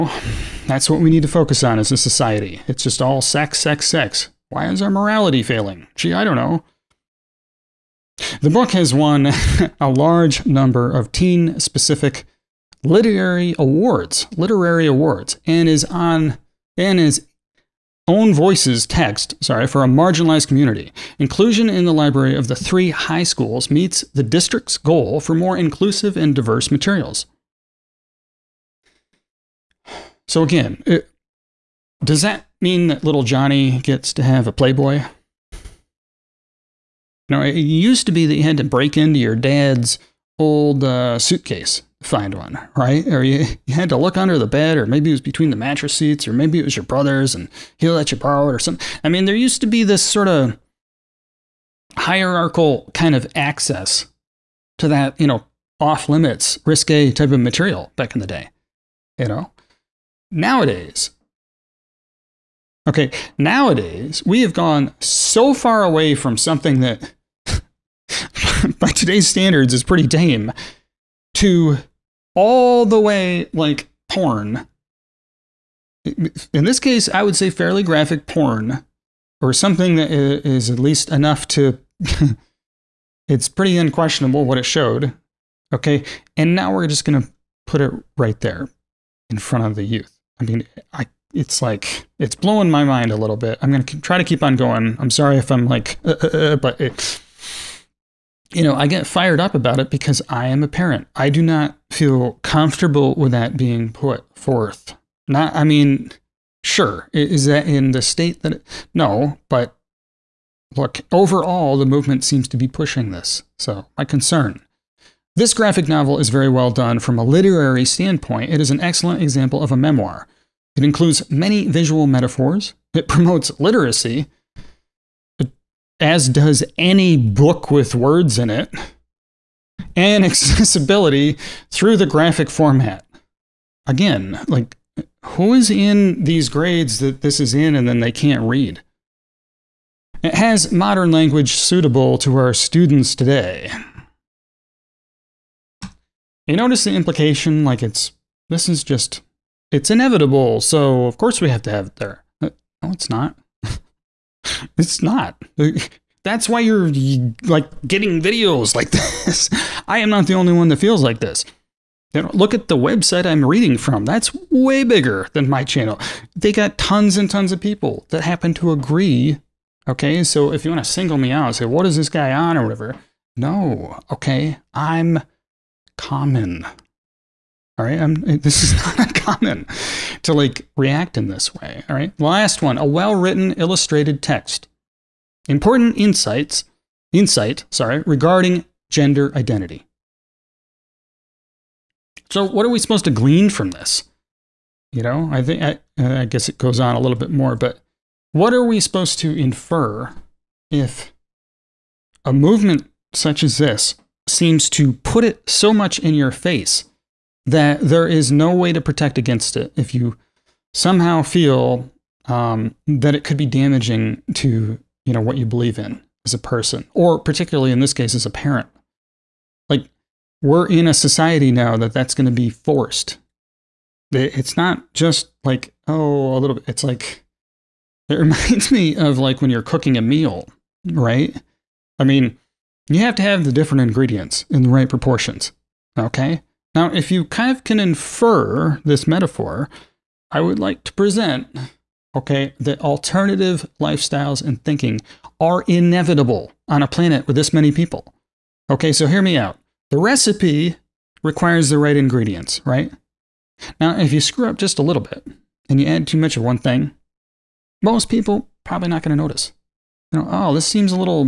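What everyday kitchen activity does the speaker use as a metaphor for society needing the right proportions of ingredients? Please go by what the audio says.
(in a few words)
Cooking a meal.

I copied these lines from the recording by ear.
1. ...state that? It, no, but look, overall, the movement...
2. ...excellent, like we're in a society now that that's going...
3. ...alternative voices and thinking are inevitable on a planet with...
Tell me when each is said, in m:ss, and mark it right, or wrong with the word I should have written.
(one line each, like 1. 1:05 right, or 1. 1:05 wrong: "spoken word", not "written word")
1. 1:48 right
2. 3:38 wrong: "parent", not "excellent"
3. 4:02 wrong: "lifestyles", not "voices".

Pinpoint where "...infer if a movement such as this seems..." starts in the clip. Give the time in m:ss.
3:19.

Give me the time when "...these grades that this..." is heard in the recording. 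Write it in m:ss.
2:16.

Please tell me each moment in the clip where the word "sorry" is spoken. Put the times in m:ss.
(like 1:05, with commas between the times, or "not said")
0:19, 1:35, 3:07.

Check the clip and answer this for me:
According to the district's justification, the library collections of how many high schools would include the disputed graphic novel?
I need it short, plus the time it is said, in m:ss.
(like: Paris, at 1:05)
3, at 0:22.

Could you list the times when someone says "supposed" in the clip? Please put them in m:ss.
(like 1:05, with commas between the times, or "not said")
3:12, 3:18.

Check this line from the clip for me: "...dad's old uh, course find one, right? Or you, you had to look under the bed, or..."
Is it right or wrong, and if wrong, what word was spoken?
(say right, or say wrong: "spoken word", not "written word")
wrong: "suitcase", not "course".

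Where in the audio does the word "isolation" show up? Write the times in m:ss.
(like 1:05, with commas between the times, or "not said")
not said.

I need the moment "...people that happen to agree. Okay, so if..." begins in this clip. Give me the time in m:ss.
2:47.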